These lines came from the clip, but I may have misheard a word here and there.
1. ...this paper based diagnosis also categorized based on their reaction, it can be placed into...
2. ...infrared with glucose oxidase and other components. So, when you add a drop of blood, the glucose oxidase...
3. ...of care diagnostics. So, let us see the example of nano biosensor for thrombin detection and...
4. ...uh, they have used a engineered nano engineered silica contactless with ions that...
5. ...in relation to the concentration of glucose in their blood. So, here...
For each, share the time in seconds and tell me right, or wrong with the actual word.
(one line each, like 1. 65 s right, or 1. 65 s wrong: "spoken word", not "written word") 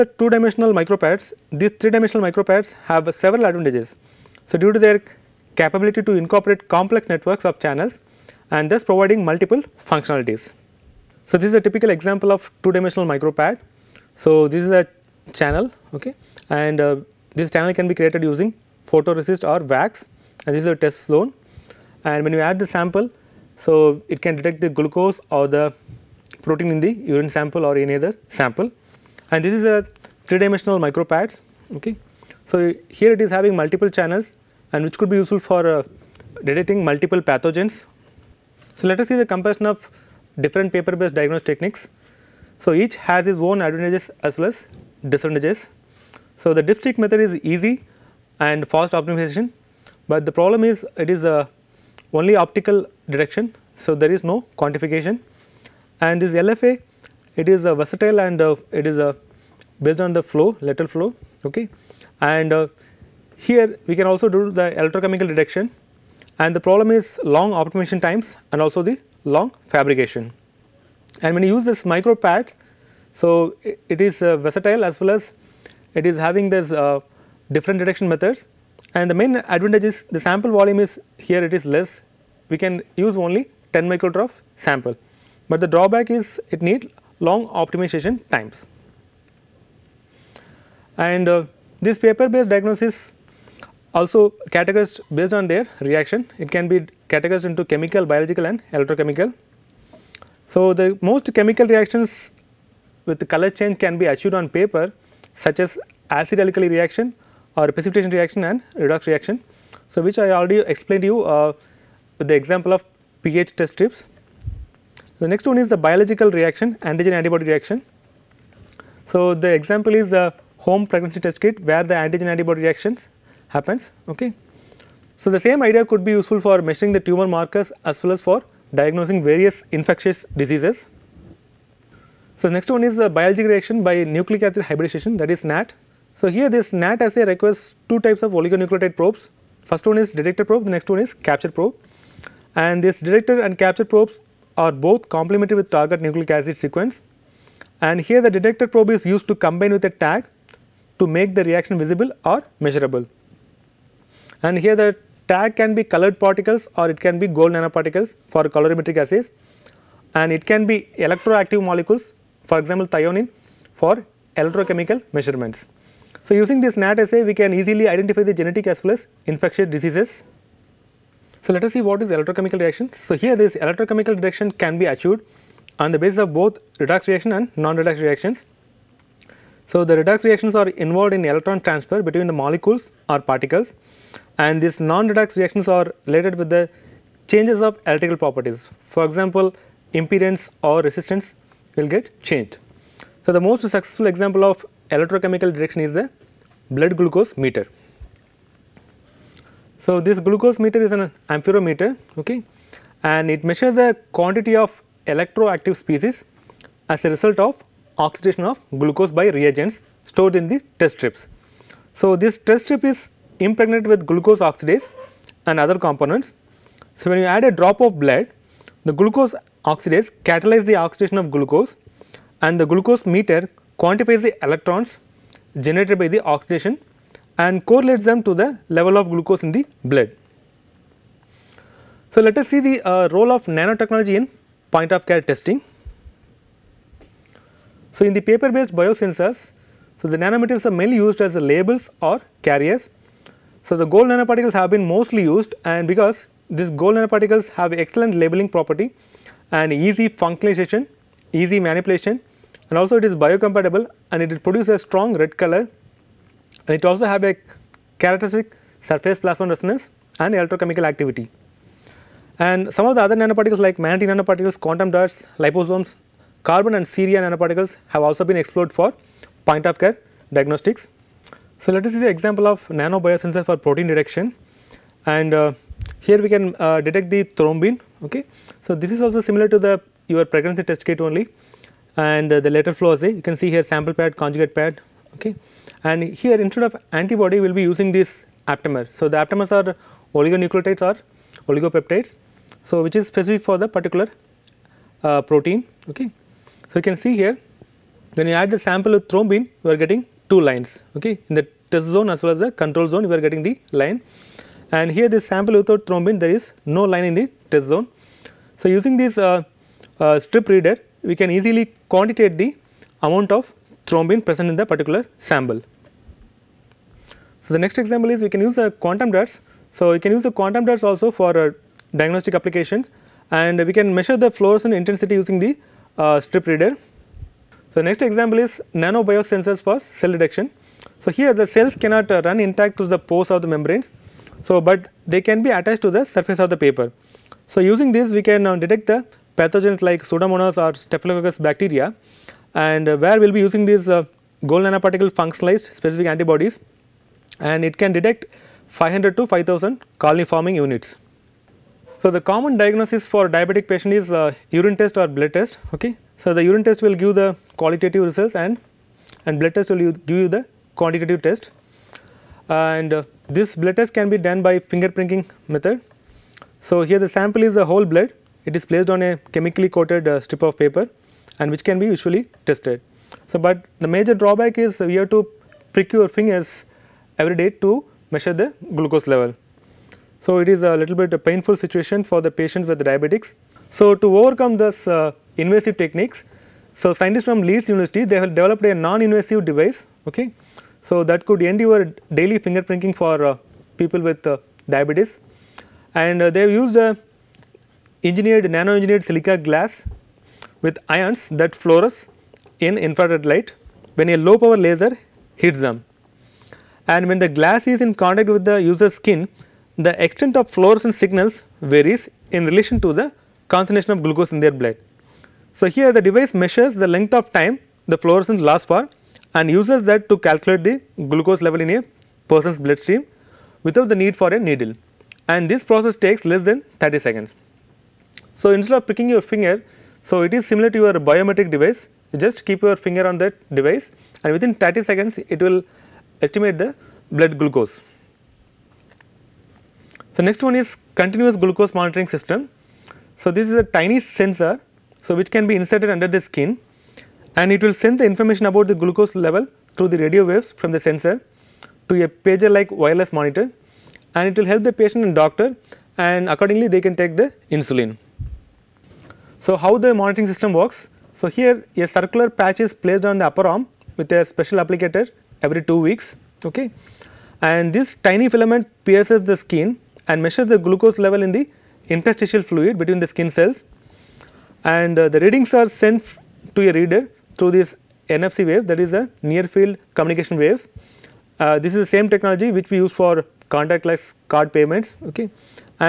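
1. 91 s wrong: "categorized", not "placed"
2. 213 s wrong: "impregnated", not "infrared"
3. 269 s wrong: "protein", not "thrombin"
4. 396 s wrong: "glass", not "contactless"
5. 412 s right.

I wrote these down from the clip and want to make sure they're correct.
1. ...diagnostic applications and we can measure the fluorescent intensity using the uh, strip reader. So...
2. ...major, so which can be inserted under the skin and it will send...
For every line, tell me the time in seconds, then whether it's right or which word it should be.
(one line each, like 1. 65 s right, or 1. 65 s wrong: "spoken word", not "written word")
1. 321 s right
2. 444 s wrong: "sensor", not "major".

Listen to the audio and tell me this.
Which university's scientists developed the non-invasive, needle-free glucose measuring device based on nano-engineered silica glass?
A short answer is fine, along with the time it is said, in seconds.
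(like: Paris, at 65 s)
Leeds University, at 387 s.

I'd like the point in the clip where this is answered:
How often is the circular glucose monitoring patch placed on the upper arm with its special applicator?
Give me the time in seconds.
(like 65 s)
465 s.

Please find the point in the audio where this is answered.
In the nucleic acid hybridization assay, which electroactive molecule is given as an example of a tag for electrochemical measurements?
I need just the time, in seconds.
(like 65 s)
162 s.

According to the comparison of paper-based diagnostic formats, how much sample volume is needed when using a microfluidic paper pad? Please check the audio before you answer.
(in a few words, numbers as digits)
10 microliter.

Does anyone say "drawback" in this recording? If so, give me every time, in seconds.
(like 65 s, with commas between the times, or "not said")
85 s, 374 s.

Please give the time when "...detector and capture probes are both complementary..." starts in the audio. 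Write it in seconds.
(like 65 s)
143 s.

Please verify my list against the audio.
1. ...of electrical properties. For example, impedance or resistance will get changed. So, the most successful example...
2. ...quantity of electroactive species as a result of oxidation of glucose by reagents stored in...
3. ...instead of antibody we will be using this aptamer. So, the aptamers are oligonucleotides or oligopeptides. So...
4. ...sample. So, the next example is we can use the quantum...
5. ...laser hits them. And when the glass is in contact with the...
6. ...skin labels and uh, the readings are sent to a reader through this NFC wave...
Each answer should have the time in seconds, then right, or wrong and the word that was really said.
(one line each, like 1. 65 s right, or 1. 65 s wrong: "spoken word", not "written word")
1. 187 s right
2. 204 s right
3. 286 s right
4. 315 s right
5. 404 s right
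6. 473 s wrong: "cells", not "labels".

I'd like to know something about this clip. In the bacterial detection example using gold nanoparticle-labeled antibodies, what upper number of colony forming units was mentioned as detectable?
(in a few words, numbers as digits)
5000.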